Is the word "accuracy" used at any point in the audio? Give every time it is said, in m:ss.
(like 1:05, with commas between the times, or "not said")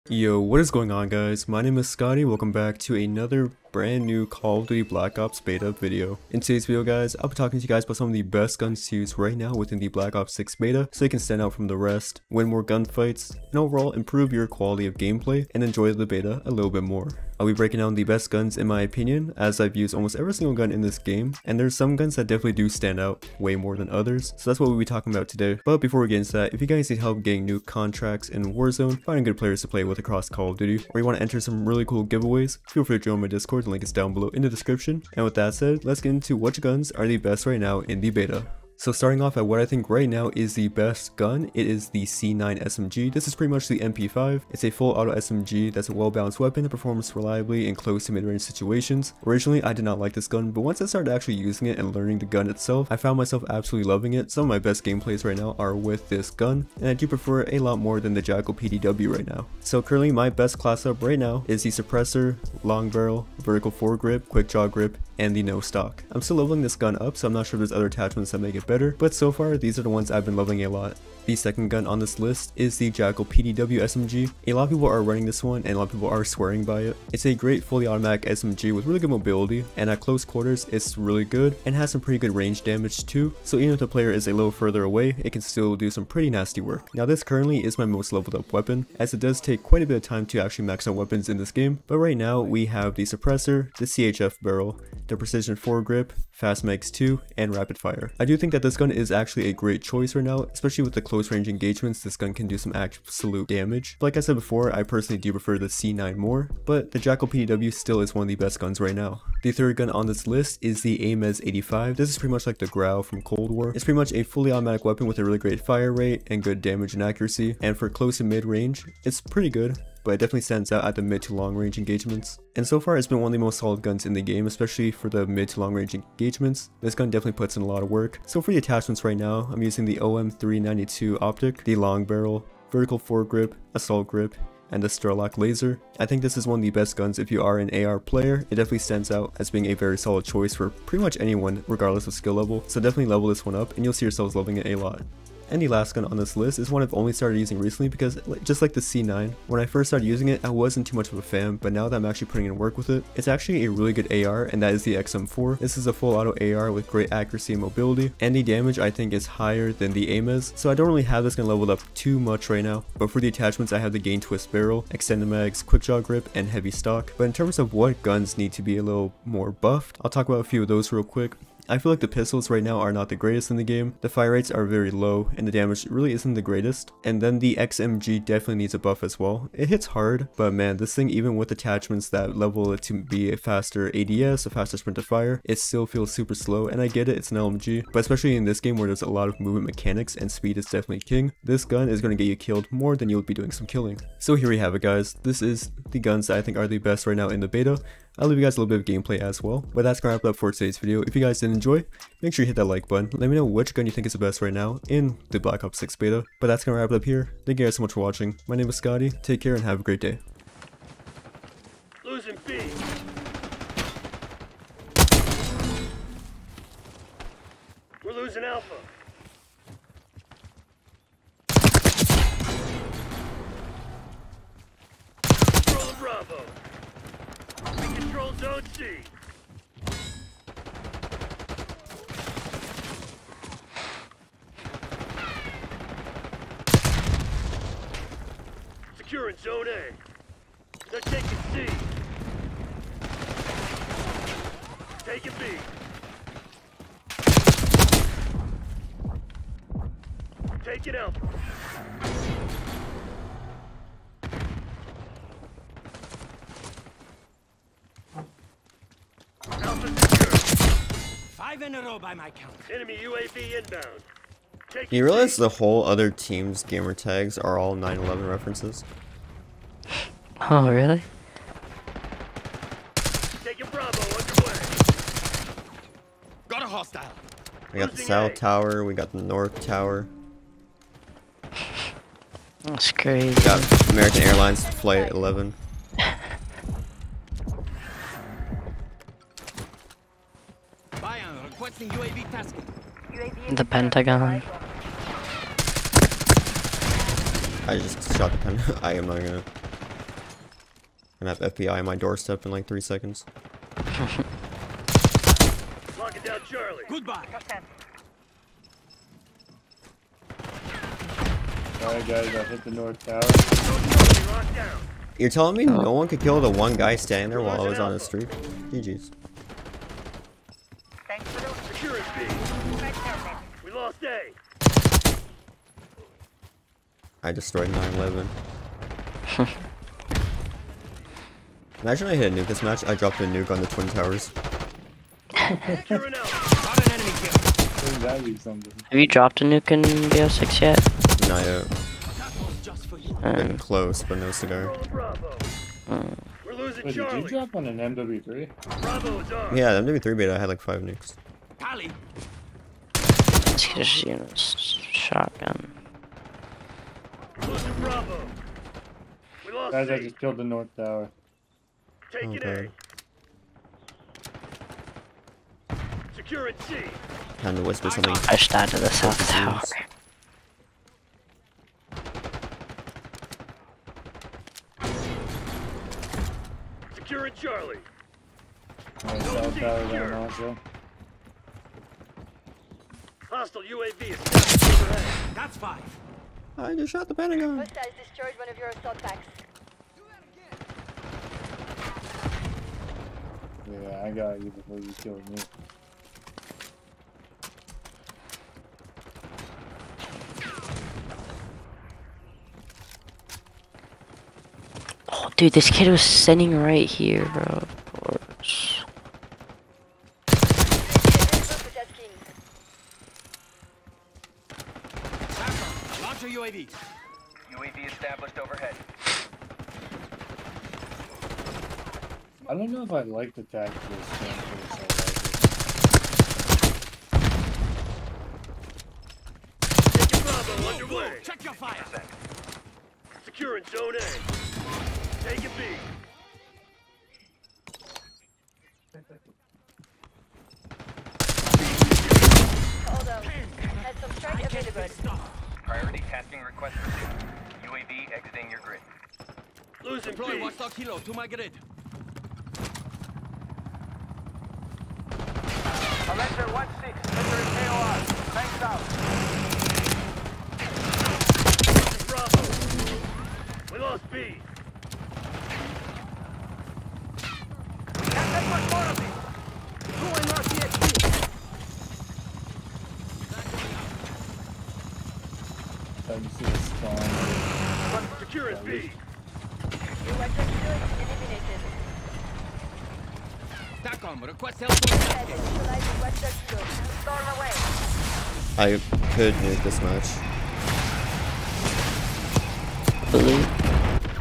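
1:57, 2:37.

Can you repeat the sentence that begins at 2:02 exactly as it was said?
And so far it's been one of the most solid guns in the game, especially for the mid to long range engagements.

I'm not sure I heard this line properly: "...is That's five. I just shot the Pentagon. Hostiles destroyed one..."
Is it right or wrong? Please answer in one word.
right.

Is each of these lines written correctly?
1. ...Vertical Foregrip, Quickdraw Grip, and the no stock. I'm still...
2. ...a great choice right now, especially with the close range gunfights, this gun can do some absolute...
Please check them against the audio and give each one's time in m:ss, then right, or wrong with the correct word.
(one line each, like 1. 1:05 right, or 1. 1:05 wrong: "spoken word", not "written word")
1. 1:03 right
2. 1:39 wrong: "engagements", not "gunfights".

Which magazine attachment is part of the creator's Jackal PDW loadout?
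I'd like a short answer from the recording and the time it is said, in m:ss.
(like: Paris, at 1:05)
Fast Mags 2, at 1:36.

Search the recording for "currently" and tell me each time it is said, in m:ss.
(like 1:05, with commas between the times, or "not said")
0:59, 1:27.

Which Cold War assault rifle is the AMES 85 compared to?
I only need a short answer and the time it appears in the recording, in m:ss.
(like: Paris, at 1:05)
Growl, at 1:52.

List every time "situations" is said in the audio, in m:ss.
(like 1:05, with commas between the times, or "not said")
0:48.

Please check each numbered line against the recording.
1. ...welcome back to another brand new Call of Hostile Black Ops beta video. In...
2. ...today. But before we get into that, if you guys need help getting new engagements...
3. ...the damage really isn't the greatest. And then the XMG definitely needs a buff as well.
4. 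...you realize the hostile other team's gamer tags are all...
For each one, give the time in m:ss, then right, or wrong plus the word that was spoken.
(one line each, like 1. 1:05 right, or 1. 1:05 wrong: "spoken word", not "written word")
1. 0:02 wrong: "Duty", not "Hostile"
2. 0:25 wrong: "contracts", not "engagements"
3. 2:55 right
4. 4:24 wrong: "whole", not "hostile".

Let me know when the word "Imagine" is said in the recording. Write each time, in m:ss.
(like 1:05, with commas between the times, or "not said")
5:31.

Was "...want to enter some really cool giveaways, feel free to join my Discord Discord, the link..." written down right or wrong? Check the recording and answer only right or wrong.
right.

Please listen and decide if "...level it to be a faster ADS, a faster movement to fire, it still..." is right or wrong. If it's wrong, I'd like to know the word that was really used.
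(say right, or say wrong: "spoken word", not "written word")
wrong: "sprint", not "movement".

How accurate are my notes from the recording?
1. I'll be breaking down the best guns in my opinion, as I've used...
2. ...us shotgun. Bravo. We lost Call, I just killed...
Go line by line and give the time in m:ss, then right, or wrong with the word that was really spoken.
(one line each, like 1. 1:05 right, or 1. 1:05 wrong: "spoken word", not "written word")
1. 0:17 right
2. 5:54 wrong: "Guys", not "Call".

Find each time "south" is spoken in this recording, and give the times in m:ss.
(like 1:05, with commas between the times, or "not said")
4:37, 6:08, 6:19.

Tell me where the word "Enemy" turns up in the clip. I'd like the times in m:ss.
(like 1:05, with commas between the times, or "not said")
4:22.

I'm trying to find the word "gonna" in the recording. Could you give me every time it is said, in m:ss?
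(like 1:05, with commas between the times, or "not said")
3:20, 3:26, 4:59.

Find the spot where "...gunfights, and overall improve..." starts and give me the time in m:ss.
0:12.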